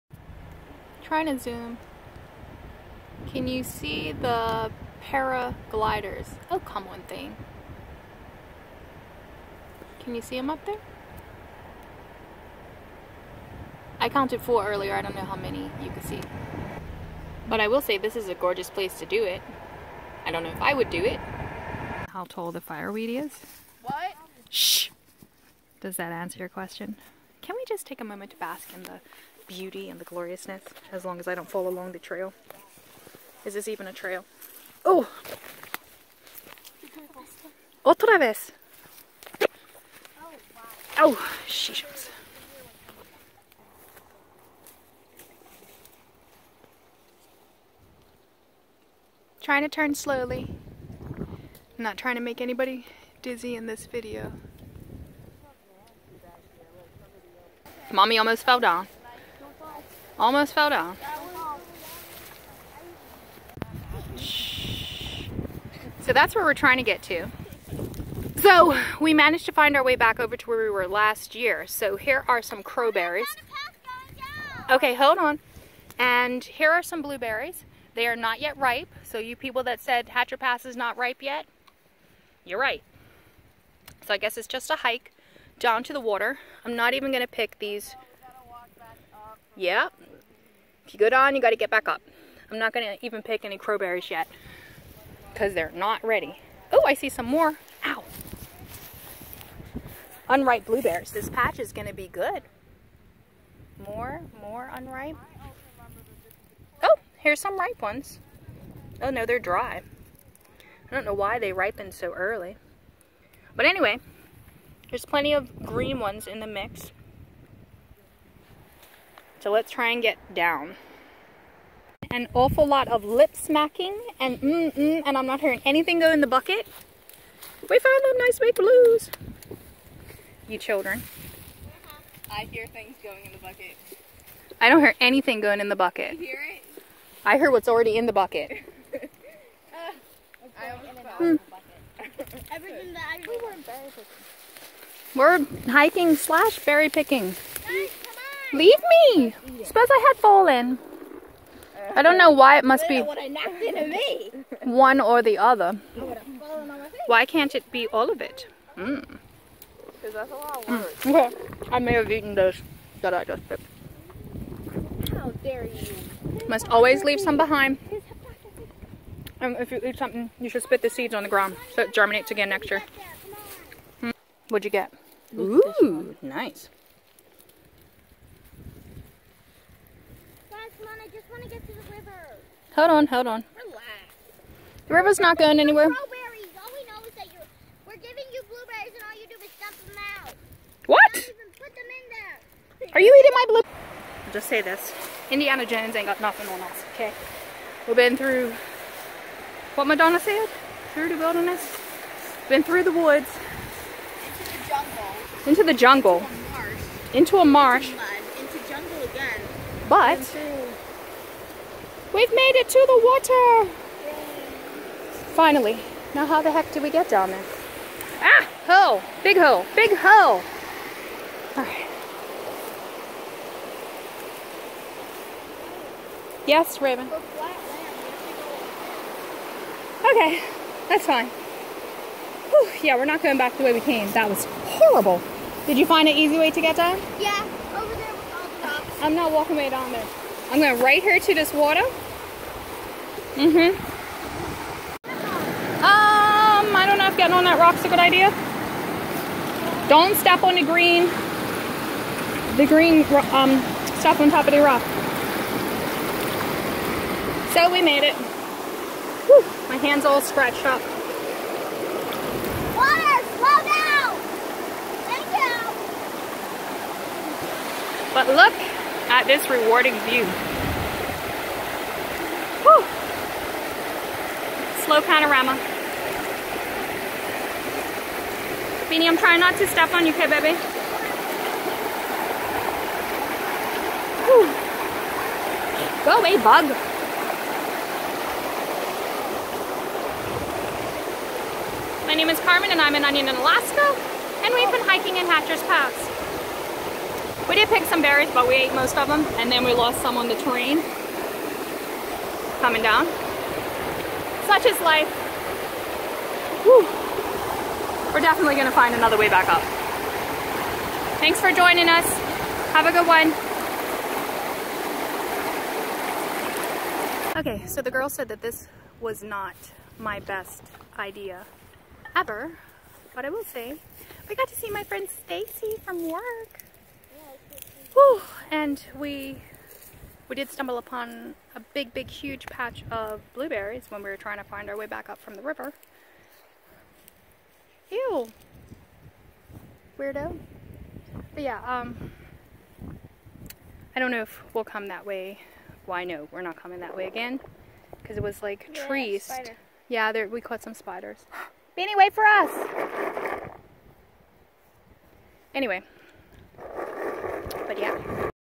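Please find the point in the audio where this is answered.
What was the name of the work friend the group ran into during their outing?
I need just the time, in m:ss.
5:25.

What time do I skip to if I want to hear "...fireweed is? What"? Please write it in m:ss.
0:22.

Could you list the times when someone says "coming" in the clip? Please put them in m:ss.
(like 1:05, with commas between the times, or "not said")
5:02, 5:46.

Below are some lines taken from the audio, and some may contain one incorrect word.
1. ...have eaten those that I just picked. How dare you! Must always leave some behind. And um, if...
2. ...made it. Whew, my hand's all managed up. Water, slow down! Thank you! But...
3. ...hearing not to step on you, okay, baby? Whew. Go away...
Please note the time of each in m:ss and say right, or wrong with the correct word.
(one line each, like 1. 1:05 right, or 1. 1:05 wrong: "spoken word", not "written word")
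1. 2:41 right
2. 4:17 wrong: "scratched", not "managed"
3. 4:39 wrong: "trying", not "hearing".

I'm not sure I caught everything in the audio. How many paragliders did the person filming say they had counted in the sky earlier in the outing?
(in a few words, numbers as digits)
4.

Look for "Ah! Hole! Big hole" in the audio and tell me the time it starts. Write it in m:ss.
3:38.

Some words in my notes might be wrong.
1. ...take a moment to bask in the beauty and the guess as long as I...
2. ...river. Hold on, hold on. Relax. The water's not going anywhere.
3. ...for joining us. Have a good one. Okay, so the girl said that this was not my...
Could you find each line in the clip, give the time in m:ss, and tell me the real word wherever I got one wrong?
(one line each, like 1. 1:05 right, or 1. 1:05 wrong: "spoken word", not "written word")
1. 0:27 wrong: "gloriousness", not "guess"
2. 3:01 wrong: "river", not "water"
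3. 5:11 right.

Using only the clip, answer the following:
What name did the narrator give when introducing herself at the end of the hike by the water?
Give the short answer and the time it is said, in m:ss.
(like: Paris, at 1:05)
Carmen, at 4:52.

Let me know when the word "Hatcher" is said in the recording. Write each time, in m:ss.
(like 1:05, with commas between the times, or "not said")
1:20, 4:55.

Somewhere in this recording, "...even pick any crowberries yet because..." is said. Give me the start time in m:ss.
1:33.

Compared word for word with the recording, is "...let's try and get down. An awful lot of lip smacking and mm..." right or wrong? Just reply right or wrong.
right.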